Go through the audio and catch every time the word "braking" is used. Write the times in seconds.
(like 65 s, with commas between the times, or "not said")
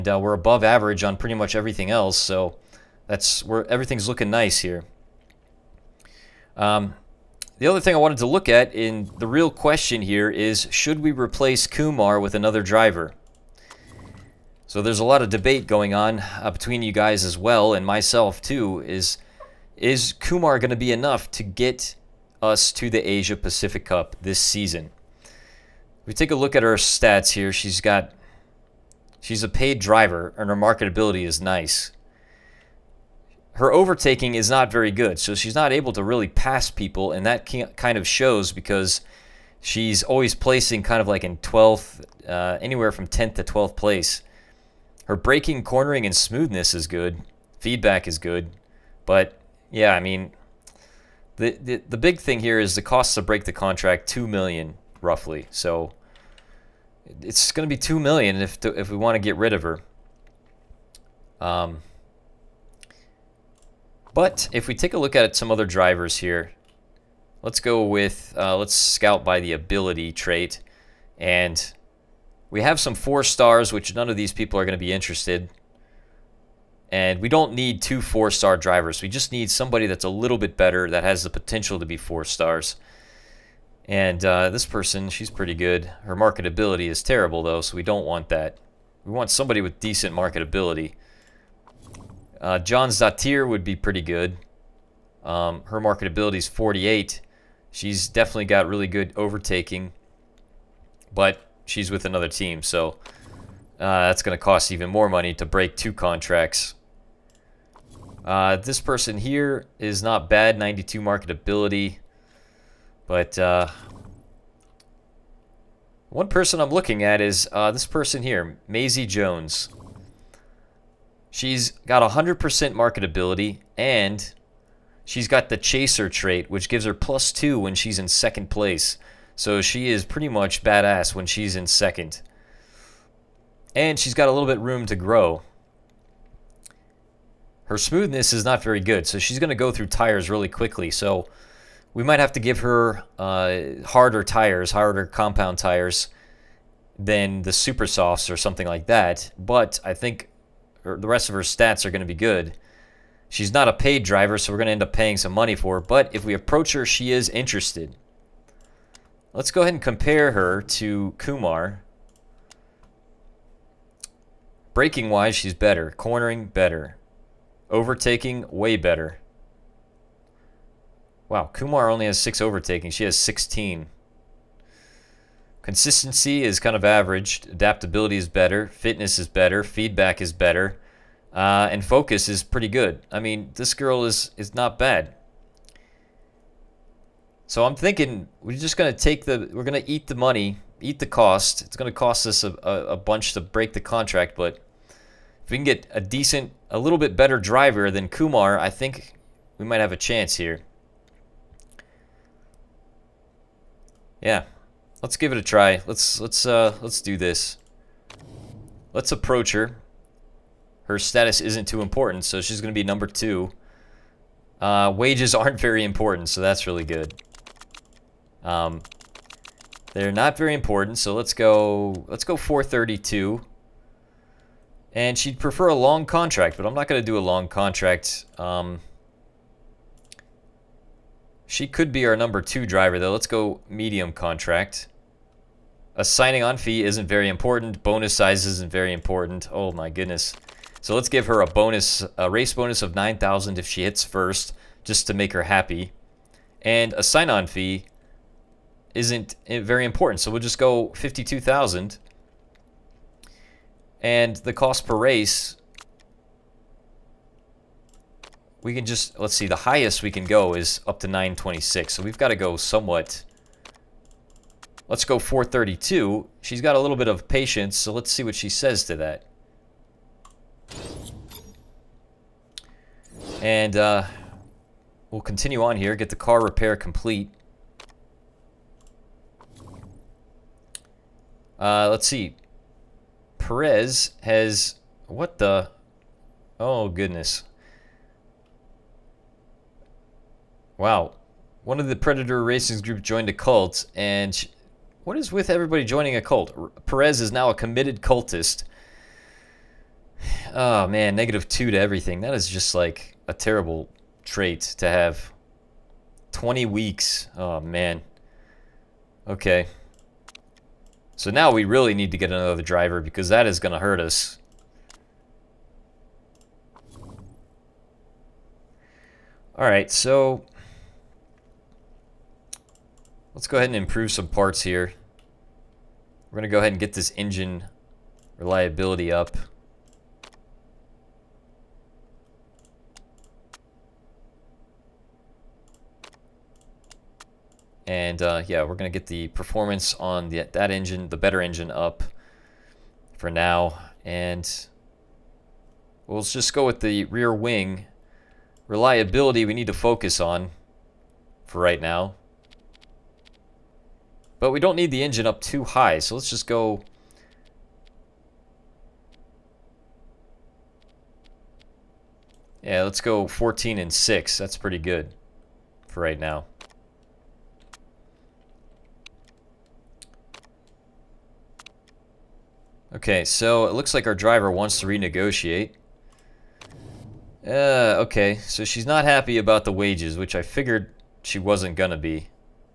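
45 s, 164 s.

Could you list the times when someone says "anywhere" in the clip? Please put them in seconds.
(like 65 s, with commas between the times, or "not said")
42 s.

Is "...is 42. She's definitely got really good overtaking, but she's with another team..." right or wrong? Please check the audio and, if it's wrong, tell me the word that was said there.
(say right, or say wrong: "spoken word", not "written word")
wrong: "48", not "42".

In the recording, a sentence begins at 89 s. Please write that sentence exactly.
We want somebody with decent marketability.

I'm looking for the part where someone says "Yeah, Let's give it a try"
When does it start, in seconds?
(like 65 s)
204 s.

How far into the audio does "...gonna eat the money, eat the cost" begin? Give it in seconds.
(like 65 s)
189 s.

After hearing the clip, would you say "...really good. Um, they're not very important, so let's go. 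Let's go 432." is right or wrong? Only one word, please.
right.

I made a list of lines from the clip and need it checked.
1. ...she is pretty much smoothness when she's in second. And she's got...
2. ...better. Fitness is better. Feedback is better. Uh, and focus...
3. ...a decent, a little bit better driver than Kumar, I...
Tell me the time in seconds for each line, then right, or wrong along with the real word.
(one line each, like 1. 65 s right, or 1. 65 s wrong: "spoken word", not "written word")
1. 129 s wrong: "badass", not "smoothness"
2. 178 s right
3. 195 s right.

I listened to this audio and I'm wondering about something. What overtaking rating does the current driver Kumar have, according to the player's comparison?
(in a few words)
6.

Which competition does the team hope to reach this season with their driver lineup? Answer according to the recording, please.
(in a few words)
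Asia Pacific Cup.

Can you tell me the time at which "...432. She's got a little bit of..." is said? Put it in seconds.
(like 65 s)
265 s.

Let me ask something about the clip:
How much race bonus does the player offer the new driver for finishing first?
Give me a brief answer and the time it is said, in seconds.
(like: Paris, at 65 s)
9,000, at 242 s.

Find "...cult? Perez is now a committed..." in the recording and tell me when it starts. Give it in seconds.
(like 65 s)
296 s.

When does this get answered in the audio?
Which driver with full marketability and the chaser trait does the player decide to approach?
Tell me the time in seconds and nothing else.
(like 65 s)
118 s.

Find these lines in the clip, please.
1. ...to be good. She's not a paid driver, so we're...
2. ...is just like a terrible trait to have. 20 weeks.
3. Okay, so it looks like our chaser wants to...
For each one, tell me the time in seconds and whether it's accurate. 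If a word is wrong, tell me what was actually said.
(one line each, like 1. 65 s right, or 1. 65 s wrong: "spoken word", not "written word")
1. 151 s right
2. 302 s right
3. 372 s wrong: "driver", not "chaser".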